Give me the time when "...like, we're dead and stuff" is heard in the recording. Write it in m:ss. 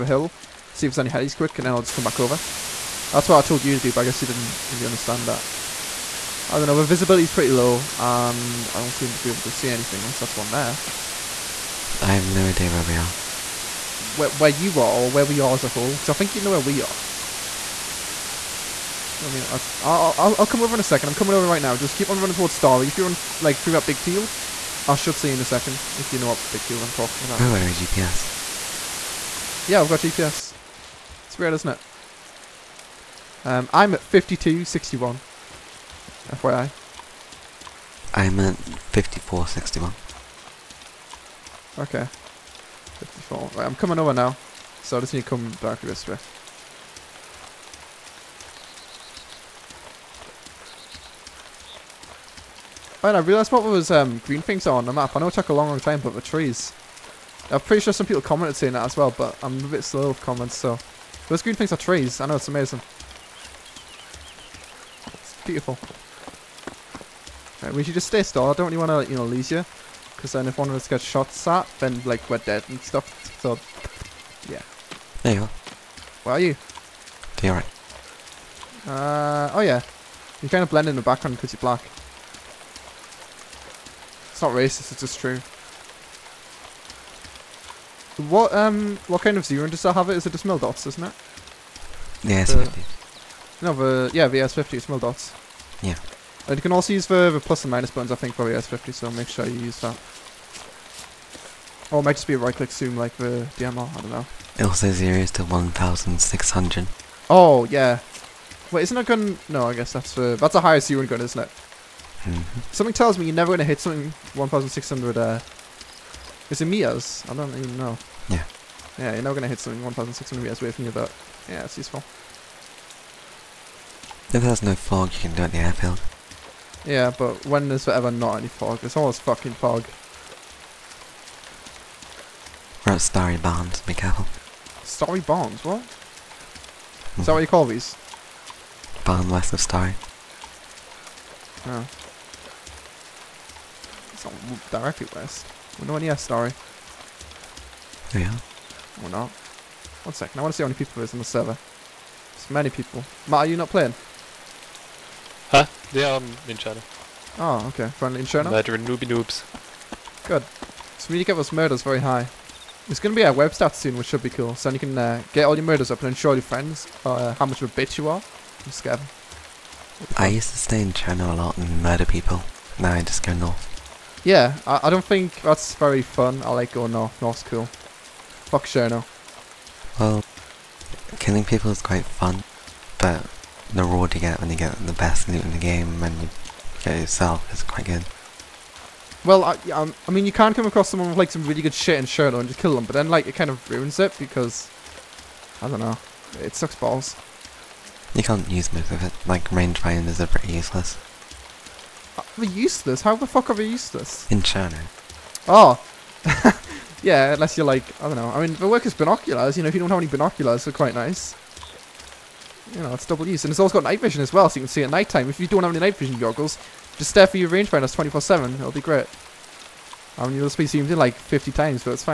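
1:12.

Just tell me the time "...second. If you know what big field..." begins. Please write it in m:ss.
0:25.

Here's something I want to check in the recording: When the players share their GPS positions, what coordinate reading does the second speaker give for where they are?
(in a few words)
54.61.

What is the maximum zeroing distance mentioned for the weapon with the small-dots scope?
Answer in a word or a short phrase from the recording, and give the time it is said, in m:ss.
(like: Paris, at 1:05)
1,600, at 1:45.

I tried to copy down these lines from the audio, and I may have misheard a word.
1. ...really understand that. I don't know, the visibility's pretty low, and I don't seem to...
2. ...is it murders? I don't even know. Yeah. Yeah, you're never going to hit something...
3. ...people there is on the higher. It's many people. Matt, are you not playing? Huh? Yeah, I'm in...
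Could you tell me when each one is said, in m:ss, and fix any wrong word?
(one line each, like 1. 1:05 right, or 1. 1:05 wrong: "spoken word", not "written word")
1. 0:04 right
2. 1:56 wrong: "meters", not "murders"
3. 2:30 wrong: "server", not "higher".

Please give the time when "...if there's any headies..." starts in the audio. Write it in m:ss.
0:00.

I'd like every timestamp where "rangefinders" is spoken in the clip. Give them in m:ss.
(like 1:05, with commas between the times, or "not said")
3:19, 3:37.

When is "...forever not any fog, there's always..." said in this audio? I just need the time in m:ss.
2:07.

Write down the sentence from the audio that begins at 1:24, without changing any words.
It's not racist, it's just true.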